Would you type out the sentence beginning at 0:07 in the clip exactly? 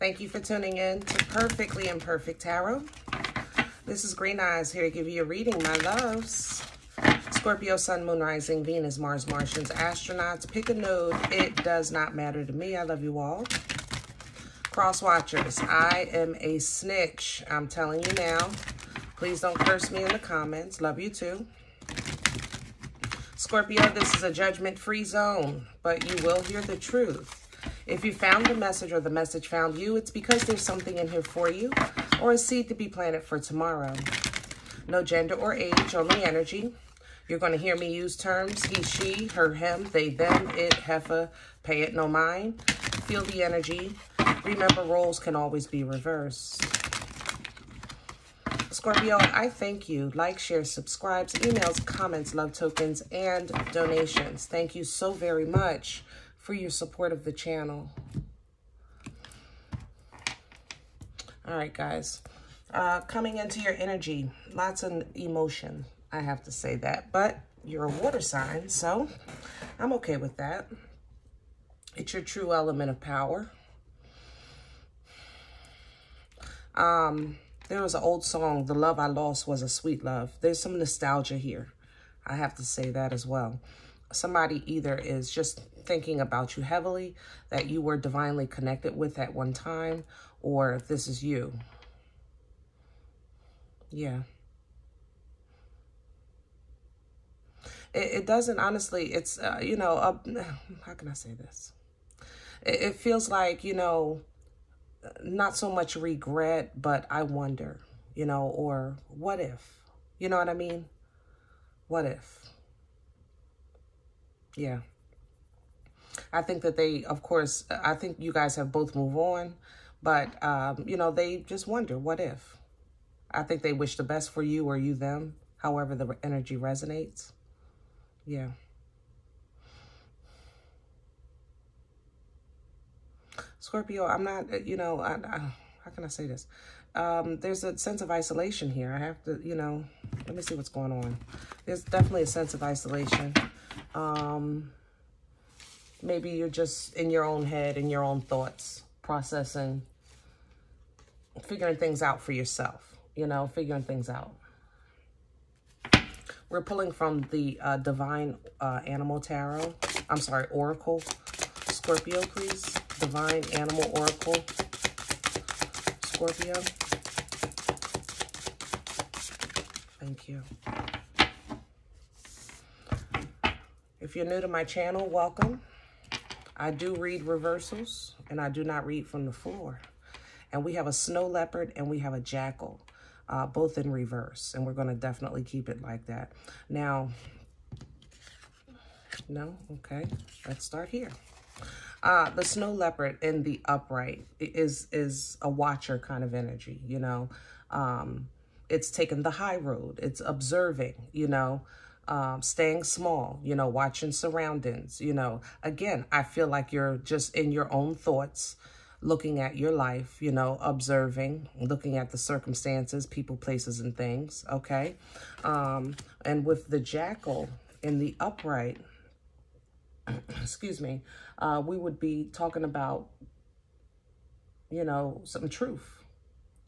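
Scorpio, Sun, Moon, Rising, Venus, Mars, Martians, Astronauts.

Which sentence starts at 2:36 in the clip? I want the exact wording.
We're pulling from the uh, Divine uh, Animal Tarot.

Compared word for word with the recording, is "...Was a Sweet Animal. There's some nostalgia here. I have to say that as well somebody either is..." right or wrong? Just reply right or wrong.
wrong.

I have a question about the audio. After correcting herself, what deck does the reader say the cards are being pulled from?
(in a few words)
Divine Animal Oracle.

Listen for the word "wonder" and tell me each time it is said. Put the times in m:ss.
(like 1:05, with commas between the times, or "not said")
1:47, 2:01.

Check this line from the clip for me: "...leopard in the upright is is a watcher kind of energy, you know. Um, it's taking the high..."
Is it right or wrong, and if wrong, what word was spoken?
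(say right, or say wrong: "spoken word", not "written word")
right.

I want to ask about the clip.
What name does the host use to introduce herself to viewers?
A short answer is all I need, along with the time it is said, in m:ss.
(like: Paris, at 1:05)
Green Eyes, at 0:04.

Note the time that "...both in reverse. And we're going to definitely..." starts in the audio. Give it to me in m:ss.
3:03.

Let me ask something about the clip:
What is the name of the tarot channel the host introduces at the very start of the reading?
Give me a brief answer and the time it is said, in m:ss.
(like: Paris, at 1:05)
Perfectly Imperfect Tarot, at 0:01.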